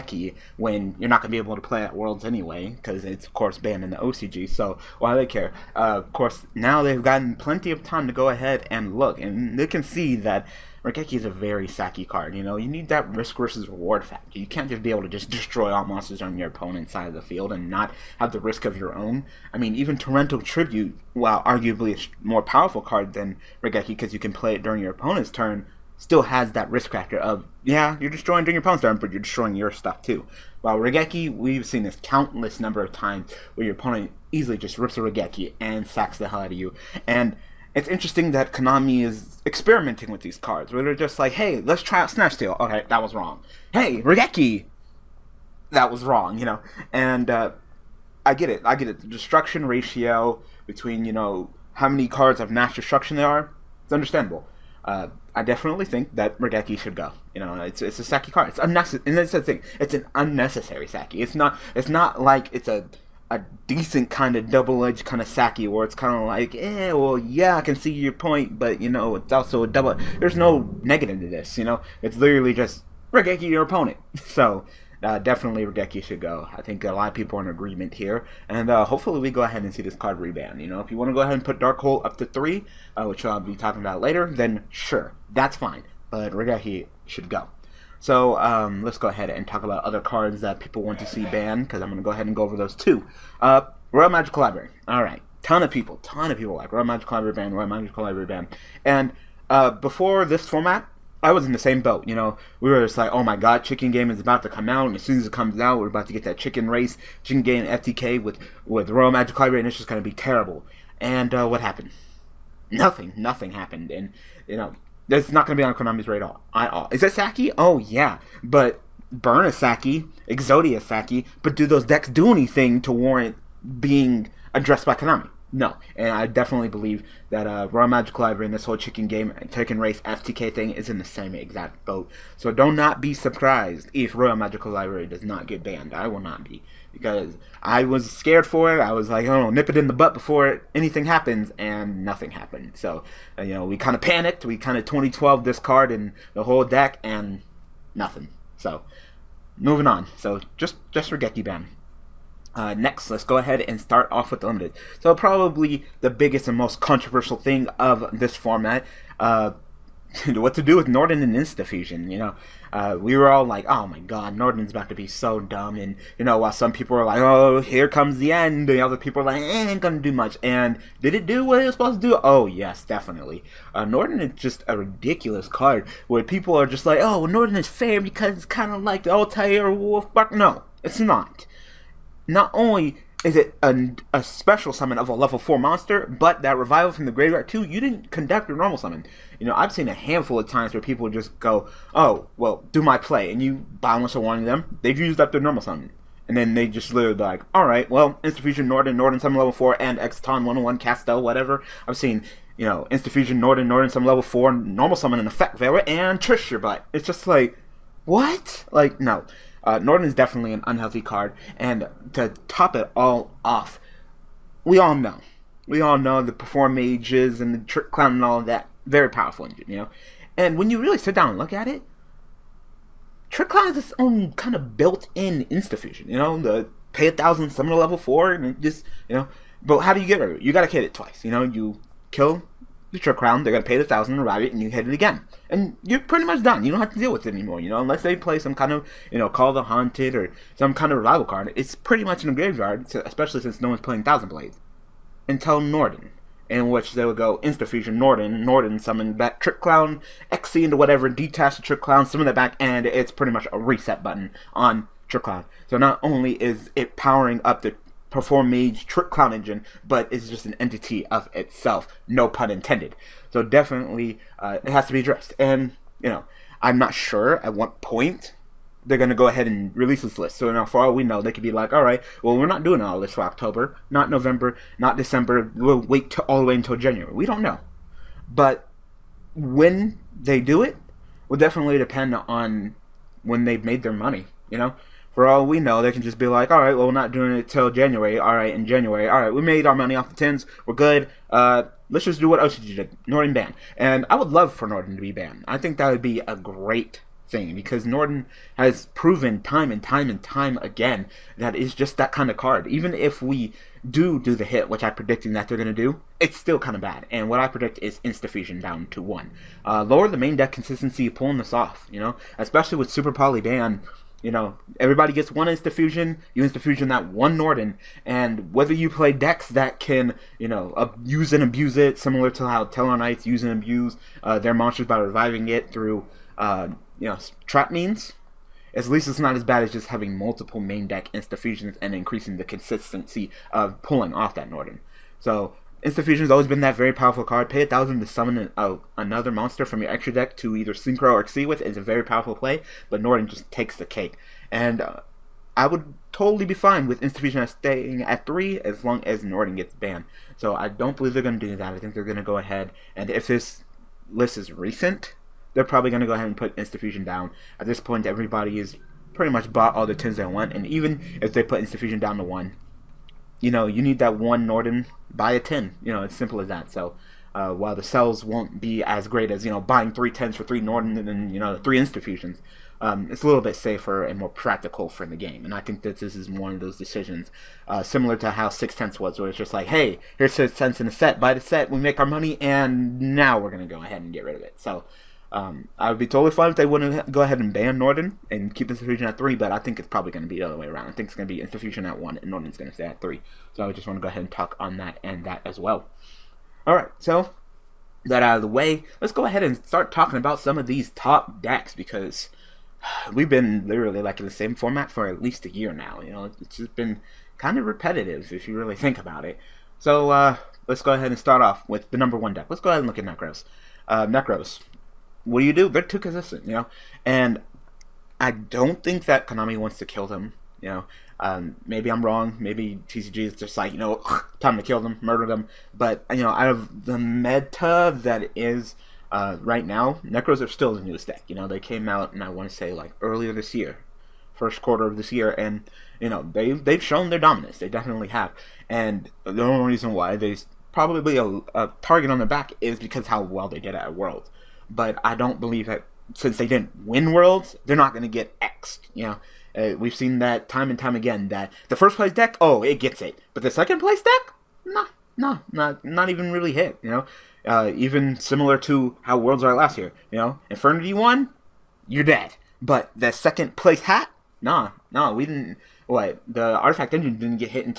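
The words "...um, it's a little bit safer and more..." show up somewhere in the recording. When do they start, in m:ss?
6:12.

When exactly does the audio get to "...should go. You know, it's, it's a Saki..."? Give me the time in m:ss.
0:56.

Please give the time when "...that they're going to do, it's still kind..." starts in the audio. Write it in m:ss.
5:05.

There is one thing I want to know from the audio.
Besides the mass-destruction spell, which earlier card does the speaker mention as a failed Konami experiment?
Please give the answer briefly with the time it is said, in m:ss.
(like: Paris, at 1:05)
Snatch Steal, at 0:42.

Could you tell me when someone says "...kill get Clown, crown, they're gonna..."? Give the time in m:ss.
3:52.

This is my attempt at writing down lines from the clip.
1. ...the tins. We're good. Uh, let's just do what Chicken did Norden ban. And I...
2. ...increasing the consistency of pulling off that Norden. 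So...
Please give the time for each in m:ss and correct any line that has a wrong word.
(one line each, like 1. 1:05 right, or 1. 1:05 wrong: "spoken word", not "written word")
1. 4:50 wrong: "OCG", not "Chicken"
2. 5:31 right.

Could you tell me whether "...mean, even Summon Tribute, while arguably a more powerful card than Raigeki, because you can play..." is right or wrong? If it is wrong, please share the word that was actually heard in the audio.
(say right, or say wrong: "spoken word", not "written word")
wrong: "Torrential", not "Summon".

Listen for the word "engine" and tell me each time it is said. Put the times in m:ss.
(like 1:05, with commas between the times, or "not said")
3:39, 4:19, 7:46.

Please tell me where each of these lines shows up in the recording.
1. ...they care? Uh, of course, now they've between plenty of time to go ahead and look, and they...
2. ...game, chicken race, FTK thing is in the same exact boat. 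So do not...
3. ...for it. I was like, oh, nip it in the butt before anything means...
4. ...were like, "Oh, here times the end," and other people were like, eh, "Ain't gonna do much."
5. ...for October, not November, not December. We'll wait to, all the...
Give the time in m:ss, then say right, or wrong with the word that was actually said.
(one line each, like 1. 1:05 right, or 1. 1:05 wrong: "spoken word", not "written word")
1. 0:05 wrong: "gotten", not "between"
2. 2:09 right
3. 2:18 wrong: "happens", not "means"
4. 2:46 wrong: "comes", not "times"
5. 4:33 right.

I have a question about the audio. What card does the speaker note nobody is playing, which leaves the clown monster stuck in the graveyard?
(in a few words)
Thousand Blades.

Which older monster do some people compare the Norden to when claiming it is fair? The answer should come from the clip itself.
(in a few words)
Taylor Wolf.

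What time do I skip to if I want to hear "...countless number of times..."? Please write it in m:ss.
0:32.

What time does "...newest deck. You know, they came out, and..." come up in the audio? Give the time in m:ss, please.
7:10.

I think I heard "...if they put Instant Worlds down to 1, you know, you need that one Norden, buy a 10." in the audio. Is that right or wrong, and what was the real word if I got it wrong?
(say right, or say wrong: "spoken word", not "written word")
wrong: "Fusion", not "Worlds".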